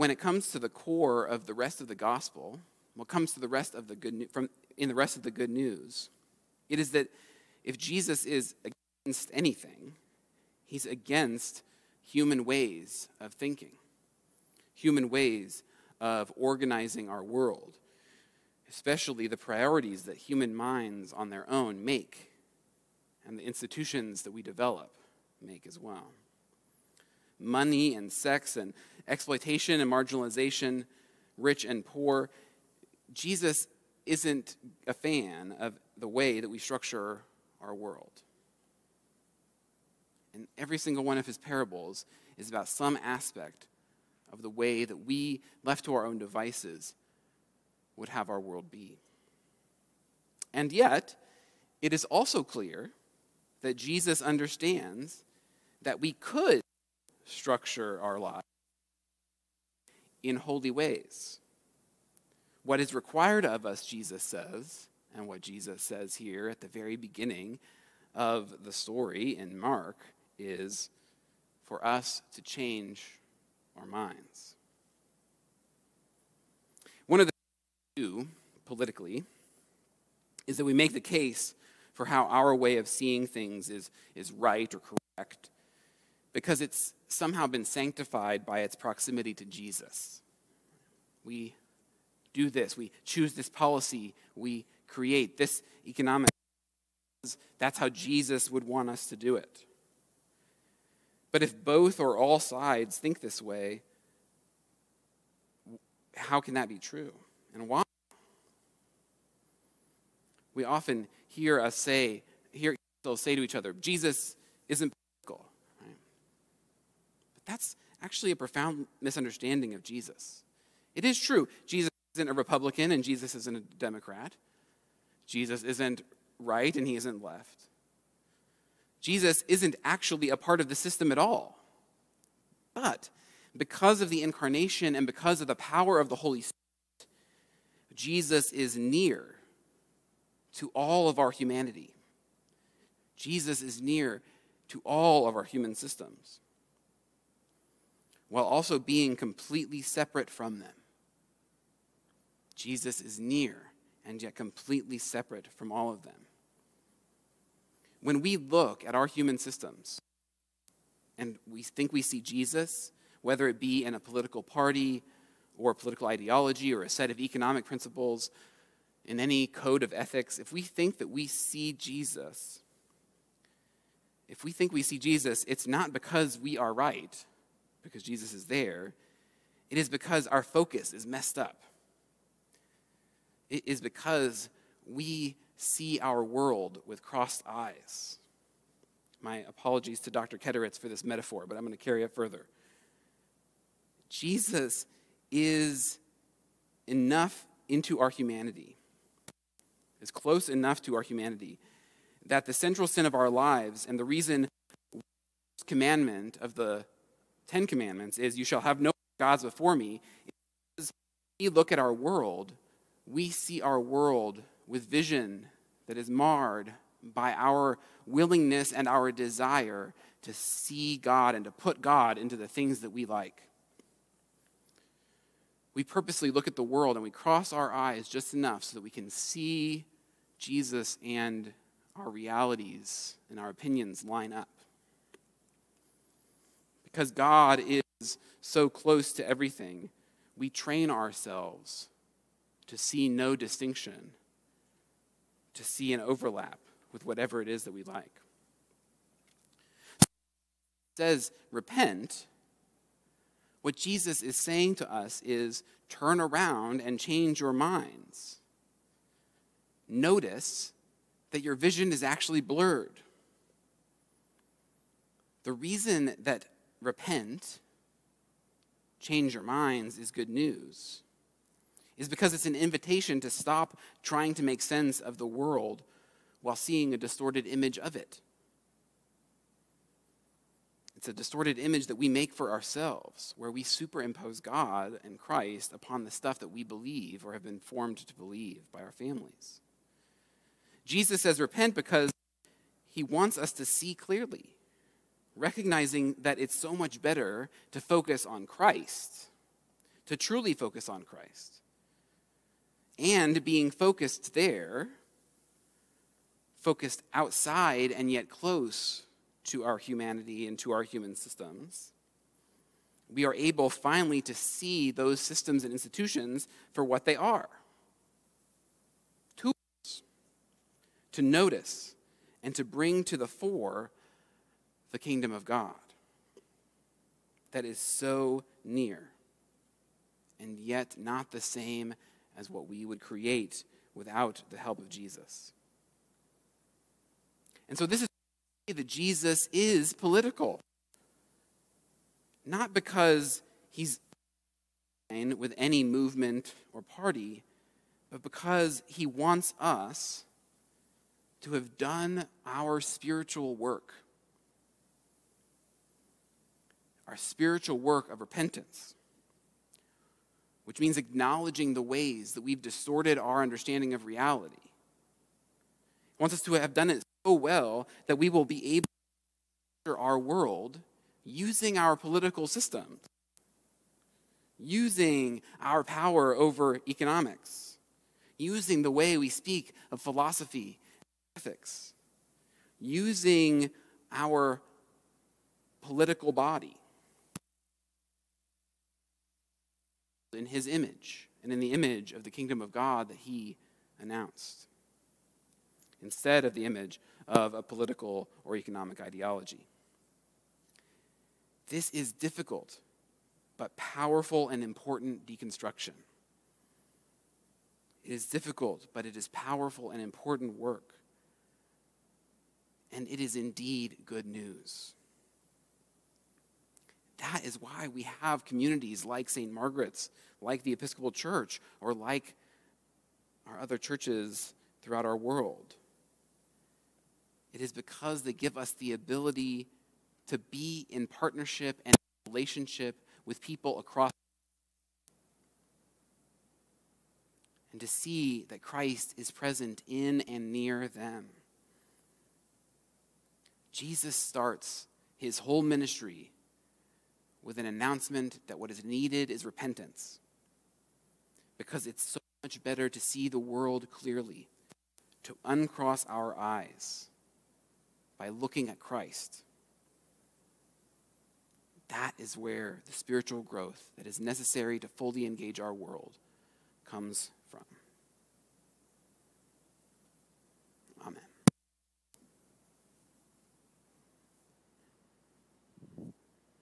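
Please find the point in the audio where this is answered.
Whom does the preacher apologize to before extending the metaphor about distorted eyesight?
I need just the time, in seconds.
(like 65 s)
190 s.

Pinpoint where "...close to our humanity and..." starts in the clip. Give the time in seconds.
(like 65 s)
308 s.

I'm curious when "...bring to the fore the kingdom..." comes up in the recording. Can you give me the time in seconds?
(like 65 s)
322 s.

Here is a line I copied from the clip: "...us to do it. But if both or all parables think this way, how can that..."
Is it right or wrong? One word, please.
wrong.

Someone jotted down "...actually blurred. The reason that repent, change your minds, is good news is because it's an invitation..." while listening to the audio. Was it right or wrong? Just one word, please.
right.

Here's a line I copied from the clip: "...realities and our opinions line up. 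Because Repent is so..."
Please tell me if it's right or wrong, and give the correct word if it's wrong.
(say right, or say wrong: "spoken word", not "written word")
wrong: "God", not "Repent".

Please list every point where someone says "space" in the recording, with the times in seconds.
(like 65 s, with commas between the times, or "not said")
not said.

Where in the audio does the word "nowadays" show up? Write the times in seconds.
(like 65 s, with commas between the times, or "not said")
not said.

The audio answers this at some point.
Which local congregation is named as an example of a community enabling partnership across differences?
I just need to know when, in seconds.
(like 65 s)
419 s.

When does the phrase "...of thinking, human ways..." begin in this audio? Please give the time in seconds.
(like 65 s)
13 s.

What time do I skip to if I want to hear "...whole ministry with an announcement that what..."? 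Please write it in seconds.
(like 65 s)
445 s.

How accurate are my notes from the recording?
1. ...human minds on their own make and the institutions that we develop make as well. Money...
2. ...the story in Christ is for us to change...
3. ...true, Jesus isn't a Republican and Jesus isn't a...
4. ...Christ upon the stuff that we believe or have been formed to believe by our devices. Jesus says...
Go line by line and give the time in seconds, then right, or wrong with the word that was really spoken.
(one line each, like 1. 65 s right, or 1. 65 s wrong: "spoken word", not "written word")
1. 20 s right
2. 68 s wrong: "Mark", not "Christ"
3. 121 s right
4. 285 s wrong: "families", not "devices".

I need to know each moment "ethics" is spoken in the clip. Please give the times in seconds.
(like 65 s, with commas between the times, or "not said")
169 s, 381 s.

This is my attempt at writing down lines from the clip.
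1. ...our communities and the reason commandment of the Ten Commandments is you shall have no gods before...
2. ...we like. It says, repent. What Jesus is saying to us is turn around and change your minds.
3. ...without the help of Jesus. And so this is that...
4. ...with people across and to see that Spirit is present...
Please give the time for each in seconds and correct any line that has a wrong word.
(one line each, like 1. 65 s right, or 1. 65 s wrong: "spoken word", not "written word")
1. 203 s wrong: "lives", not "communities"
2. 247 s right
3. 333 s right
4. 433 s wrong: "Christ", not "Spirit".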